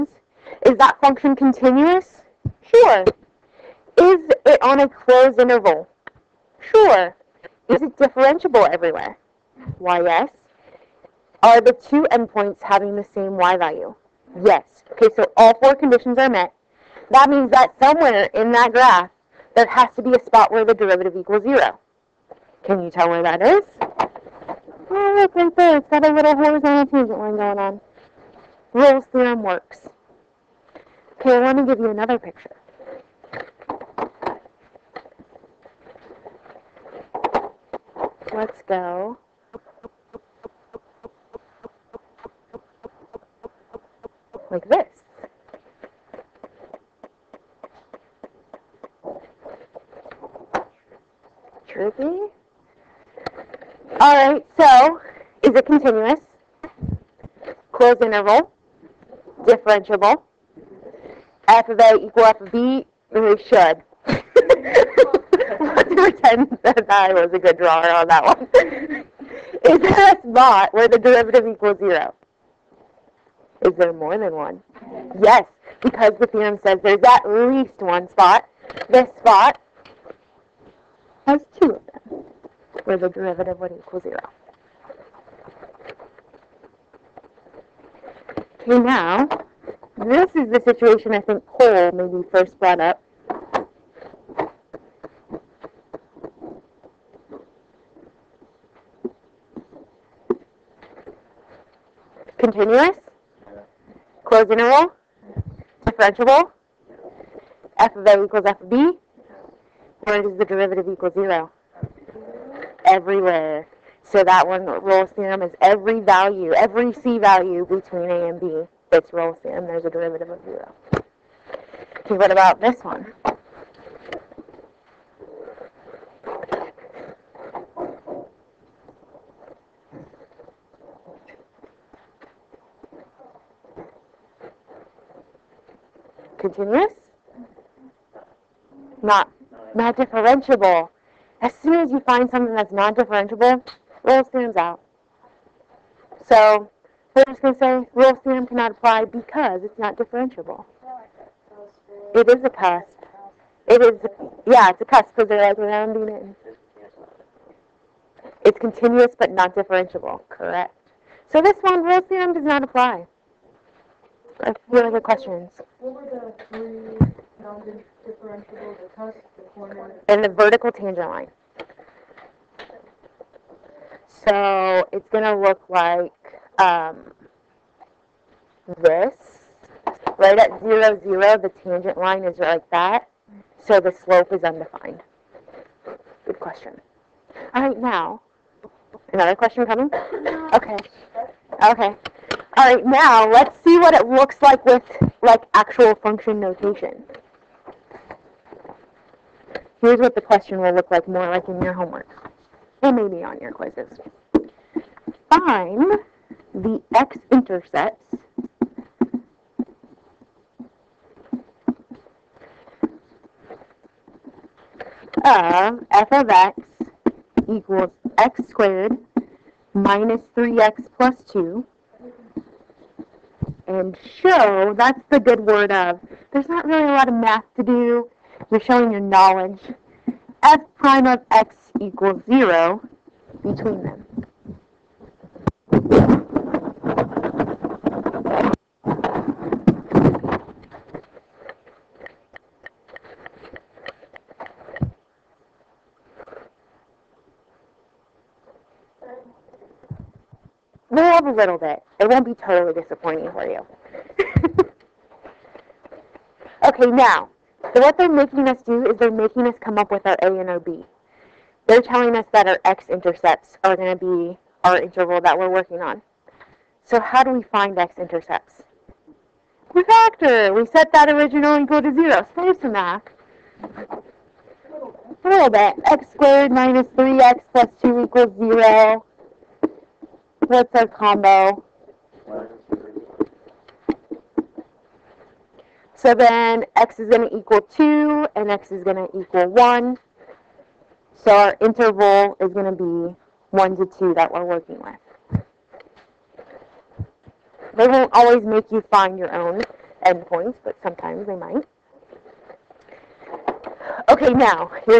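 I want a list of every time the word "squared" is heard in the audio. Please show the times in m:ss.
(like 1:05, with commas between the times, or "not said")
3:38, 4:36.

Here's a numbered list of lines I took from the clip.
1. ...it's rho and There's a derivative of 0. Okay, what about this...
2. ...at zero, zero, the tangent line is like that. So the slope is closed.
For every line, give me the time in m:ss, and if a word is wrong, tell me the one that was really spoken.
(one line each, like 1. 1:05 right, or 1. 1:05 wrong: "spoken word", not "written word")
1. 1:58 right
2. 3:00 wrong: "undefined", not "closed".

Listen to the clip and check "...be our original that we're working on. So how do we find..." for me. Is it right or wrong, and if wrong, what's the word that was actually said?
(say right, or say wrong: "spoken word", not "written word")
wrong: "interval", not "original".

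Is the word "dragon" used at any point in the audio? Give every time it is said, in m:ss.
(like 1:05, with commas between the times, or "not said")
not said.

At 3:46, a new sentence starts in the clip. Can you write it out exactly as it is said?
There's not really a lot of math to do.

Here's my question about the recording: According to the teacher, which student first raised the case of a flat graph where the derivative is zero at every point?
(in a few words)
Paul.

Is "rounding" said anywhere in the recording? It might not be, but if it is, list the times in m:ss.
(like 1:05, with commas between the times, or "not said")
2:35.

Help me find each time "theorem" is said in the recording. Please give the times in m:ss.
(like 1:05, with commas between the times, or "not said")
0:29, 1:16, 1:55, 2:28, 2:42.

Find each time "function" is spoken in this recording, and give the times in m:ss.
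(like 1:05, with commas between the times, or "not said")
0:01, 3:15.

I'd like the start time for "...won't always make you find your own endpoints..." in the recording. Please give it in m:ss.
4:57.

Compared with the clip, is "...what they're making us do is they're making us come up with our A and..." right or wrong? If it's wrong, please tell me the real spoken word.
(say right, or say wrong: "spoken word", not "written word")
right.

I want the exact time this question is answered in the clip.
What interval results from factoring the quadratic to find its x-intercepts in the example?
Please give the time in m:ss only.
4:53.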